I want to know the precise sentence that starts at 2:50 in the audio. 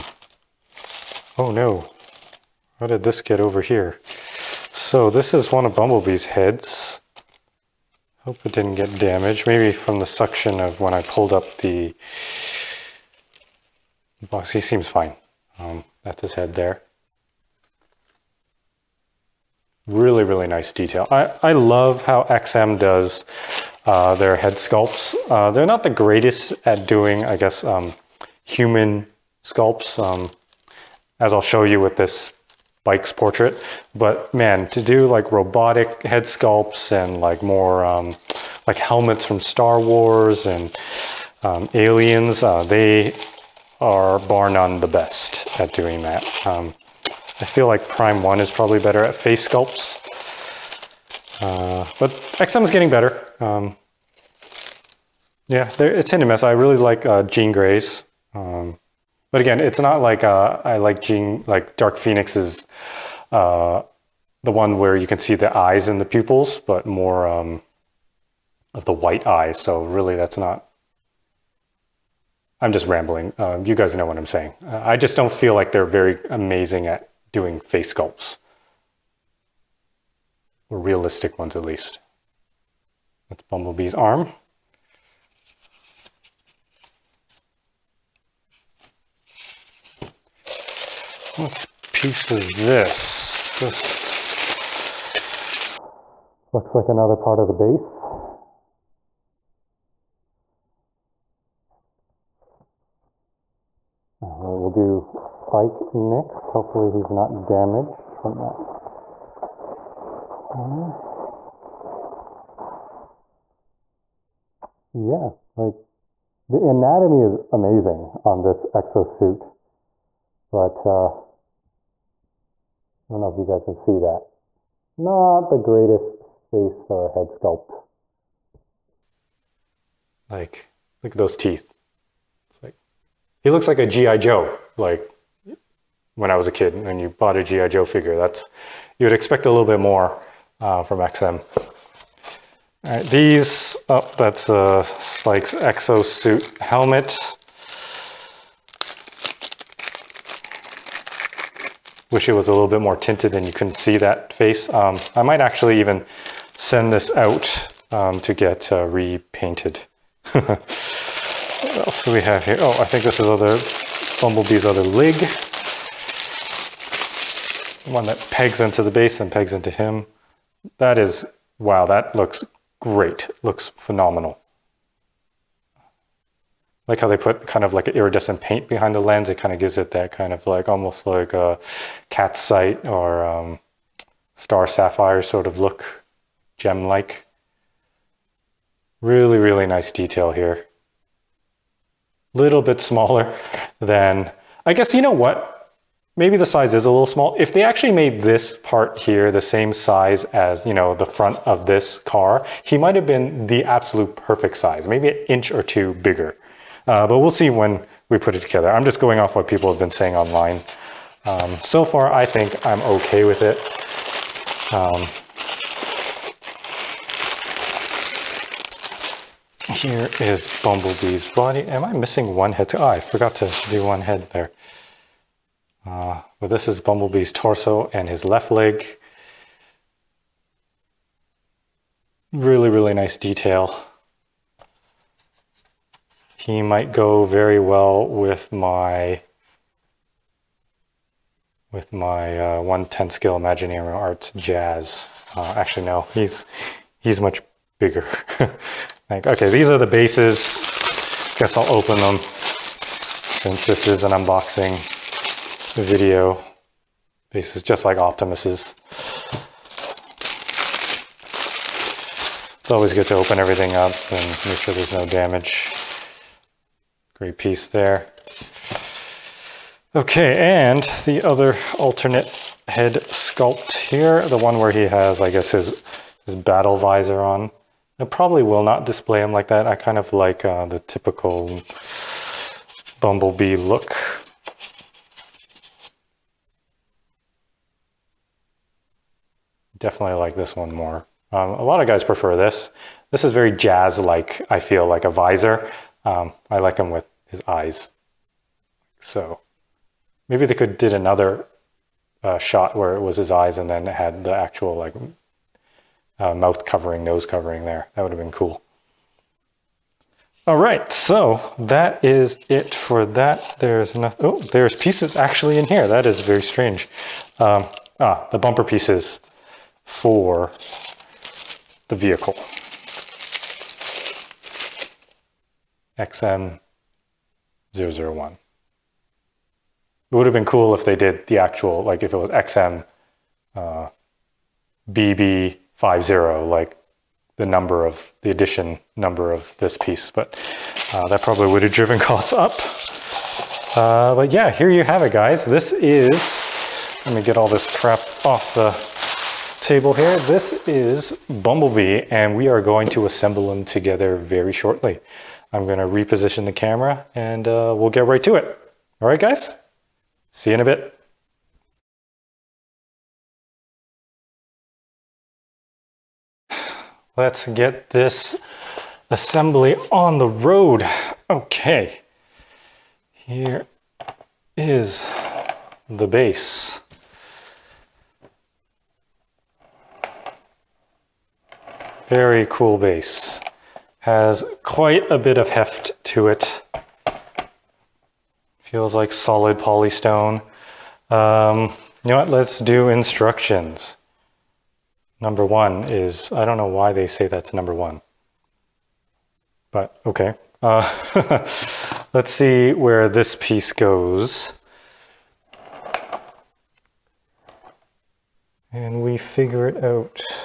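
That is, wow, that looks great.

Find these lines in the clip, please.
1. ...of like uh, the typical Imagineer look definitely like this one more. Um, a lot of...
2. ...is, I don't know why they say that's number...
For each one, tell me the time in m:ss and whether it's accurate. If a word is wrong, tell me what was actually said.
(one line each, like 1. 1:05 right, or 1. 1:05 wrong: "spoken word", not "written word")
1. 4:39 wrong: "Bumblebee", not "Imagineer"
2. 6:35 right.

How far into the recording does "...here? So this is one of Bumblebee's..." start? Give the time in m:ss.
0:03.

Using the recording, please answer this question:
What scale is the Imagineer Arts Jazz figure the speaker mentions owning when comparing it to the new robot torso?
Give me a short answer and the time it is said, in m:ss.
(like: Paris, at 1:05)
1/10, at 4:02.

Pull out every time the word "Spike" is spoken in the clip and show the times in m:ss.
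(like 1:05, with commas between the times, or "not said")
0:32, 1:45, 2:24.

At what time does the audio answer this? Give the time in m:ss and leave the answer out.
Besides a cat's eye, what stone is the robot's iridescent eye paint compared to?
3:04.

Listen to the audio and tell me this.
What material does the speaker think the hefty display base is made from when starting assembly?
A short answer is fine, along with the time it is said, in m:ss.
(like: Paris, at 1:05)
polystone, at 6:29.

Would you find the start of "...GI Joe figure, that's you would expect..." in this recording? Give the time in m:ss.
2:17.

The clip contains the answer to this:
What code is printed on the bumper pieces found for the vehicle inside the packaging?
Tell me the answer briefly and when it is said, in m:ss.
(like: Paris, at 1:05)
XM001, at 5:25.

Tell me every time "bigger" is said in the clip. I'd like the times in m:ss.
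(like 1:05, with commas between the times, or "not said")
3:25, 4:07.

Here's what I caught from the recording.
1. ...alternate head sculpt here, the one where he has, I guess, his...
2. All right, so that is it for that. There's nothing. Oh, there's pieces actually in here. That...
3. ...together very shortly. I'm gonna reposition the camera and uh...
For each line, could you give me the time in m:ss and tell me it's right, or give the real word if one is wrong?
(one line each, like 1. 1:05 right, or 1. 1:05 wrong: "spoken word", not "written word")
1. 4:31 right
2. 5:10 right
3. 5:53 right.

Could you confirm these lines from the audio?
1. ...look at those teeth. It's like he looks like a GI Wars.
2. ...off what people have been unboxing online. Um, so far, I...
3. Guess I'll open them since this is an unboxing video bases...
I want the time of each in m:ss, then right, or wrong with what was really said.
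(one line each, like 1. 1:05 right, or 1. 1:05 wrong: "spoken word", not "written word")
1. 2:11 wrong: "Joe", not "Wars"
2. 3:29 wrong: "saying", not "unboxing"
3. 4:11 right.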